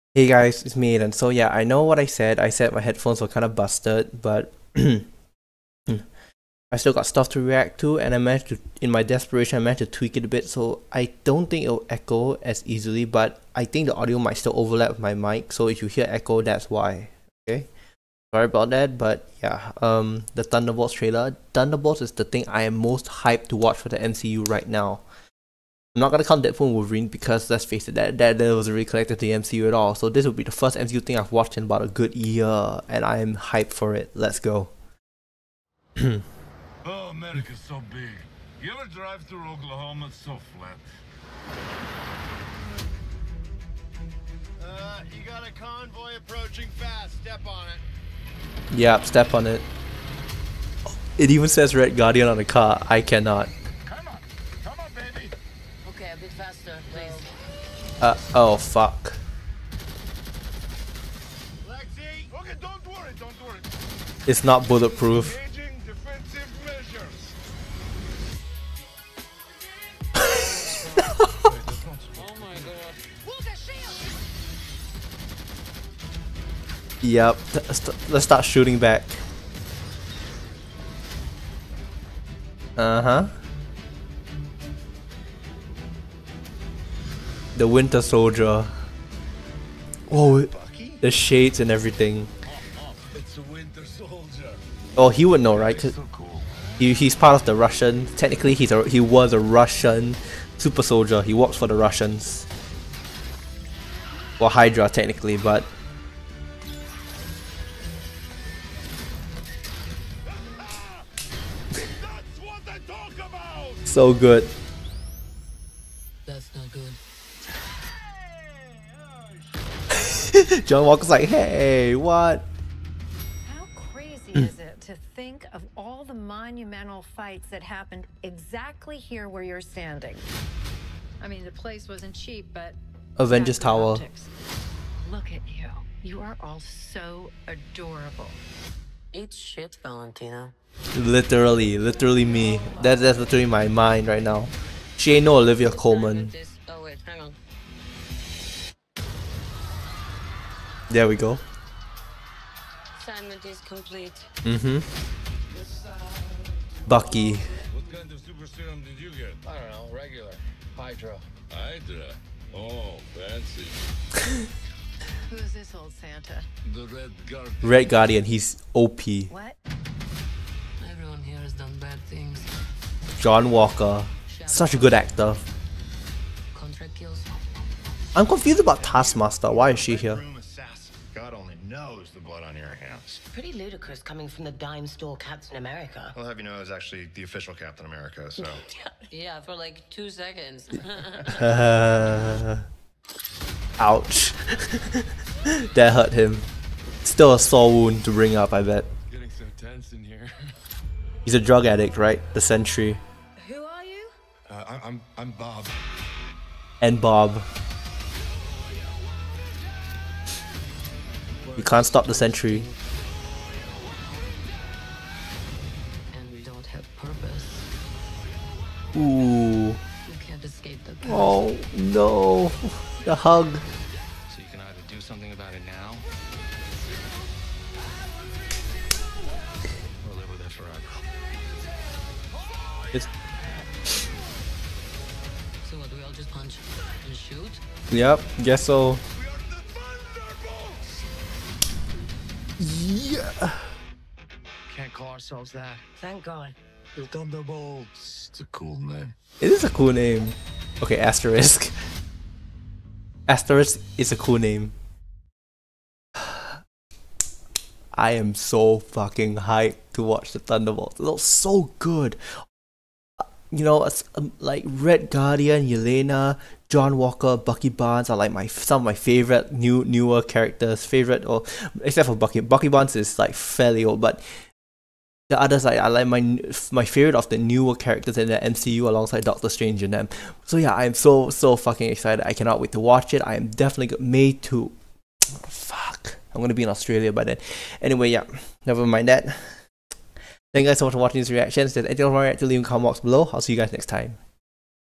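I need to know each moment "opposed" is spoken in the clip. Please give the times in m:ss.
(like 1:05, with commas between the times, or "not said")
not said.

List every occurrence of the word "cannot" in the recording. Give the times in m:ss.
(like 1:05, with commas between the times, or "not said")
0:53, 4:42.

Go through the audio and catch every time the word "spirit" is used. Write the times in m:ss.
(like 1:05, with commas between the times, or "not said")
not said.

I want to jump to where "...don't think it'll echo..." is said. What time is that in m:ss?
0:11.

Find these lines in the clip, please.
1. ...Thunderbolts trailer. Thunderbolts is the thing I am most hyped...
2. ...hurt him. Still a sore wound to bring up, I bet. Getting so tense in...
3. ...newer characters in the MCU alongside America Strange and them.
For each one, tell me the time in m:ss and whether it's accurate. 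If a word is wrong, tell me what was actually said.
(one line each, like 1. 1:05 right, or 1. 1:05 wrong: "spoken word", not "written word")
1. 0:20 right
2. 3:15 right
3. 4:37 wrong: "Doctor", not "America".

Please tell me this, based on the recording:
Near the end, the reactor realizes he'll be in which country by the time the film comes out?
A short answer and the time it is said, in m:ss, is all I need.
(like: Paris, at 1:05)
Australia, at 4:46.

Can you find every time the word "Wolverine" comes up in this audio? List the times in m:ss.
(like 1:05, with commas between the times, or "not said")
0:26.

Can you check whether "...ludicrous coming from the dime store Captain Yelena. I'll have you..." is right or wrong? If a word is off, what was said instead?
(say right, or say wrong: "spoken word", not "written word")
wrong: "America", not "Yelena".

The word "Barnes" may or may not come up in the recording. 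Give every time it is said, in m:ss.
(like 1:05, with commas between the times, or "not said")
4:27, 4:32.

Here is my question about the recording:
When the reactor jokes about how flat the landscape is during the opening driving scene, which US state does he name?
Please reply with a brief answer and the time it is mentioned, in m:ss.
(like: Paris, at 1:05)
Oklahoma, at 0:39.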